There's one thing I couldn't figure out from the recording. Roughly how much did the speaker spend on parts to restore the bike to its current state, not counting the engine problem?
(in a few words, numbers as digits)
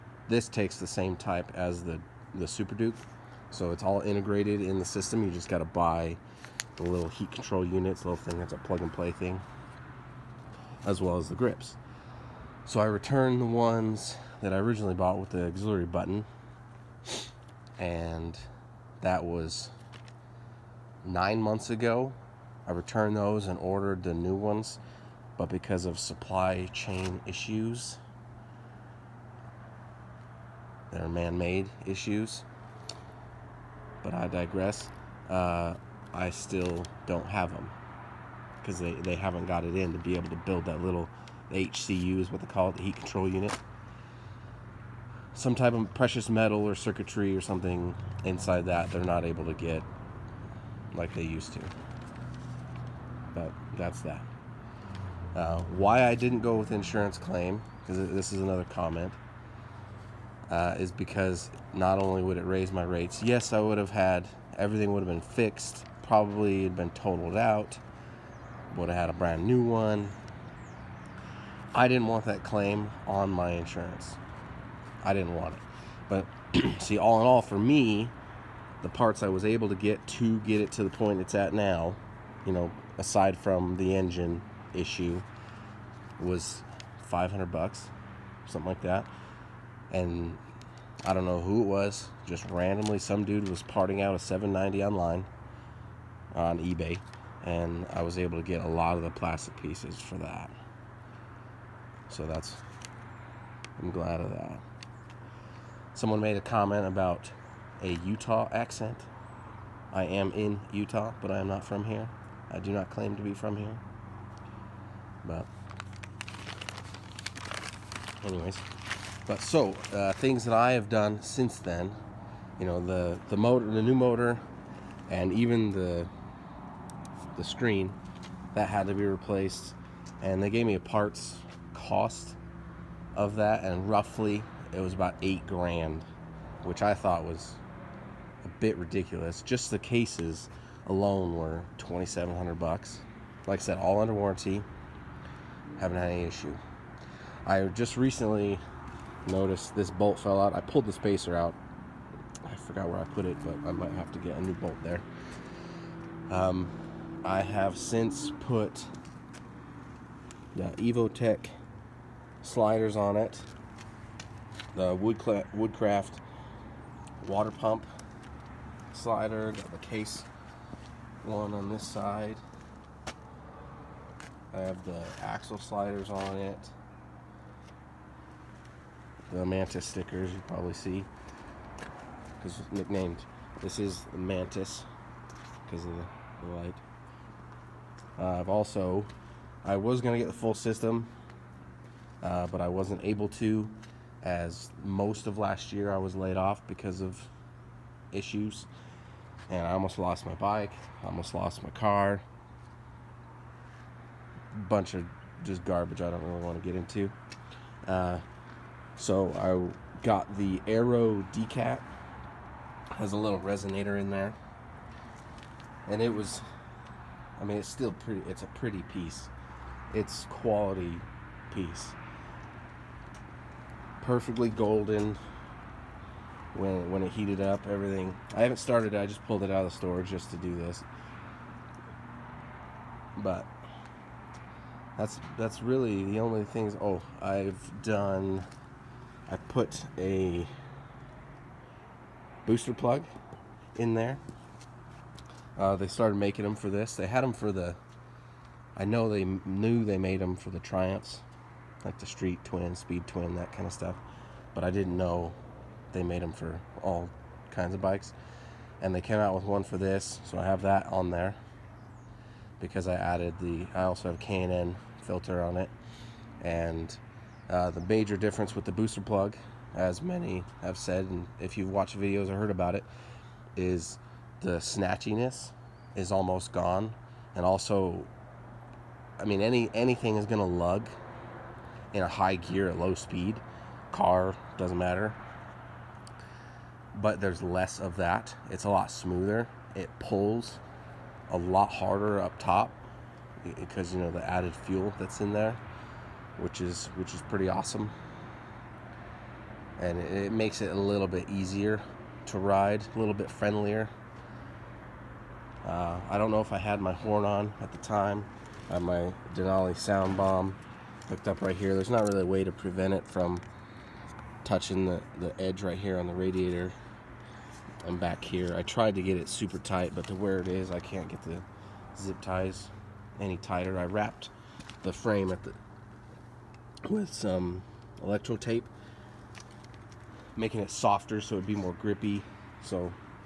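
$500.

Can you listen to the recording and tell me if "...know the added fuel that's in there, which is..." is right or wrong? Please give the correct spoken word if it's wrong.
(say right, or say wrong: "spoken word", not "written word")
right.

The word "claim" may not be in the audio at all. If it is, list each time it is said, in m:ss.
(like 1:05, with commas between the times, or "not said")
0:57, 1:12, 1:52.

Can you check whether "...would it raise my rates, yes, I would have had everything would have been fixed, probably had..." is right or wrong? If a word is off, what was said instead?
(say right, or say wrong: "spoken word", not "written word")
right.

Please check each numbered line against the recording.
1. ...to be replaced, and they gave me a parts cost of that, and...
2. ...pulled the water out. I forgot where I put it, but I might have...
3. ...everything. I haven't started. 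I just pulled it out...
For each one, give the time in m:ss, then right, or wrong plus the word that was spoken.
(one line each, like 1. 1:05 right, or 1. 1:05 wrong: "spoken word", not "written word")
1. 2:08 right
2. 2:30 wrong: "spacer", not "water"
3. 3:47 right.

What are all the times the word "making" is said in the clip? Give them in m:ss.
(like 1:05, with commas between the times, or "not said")
4:06, 5:30.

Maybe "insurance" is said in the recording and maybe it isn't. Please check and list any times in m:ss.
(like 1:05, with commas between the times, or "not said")
0:56, 1:13.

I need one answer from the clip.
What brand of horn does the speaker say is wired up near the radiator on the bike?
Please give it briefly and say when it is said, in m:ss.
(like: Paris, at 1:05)
Denali, at 5:09.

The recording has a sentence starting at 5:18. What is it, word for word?
I tried to get it super tight, but to where it is, I can't get the zip ties any tighter.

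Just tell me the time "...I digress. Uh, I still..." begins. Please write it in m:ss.
0:34.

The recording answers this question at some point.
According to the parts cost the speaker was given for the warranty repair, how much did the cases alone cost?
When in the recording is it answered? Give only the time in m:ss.
2:21.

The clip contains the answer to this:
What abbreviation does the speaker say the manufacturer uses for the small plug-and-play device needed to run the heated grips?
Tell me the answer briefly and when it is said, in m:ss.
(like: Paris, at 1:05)
HCU, at 0:41.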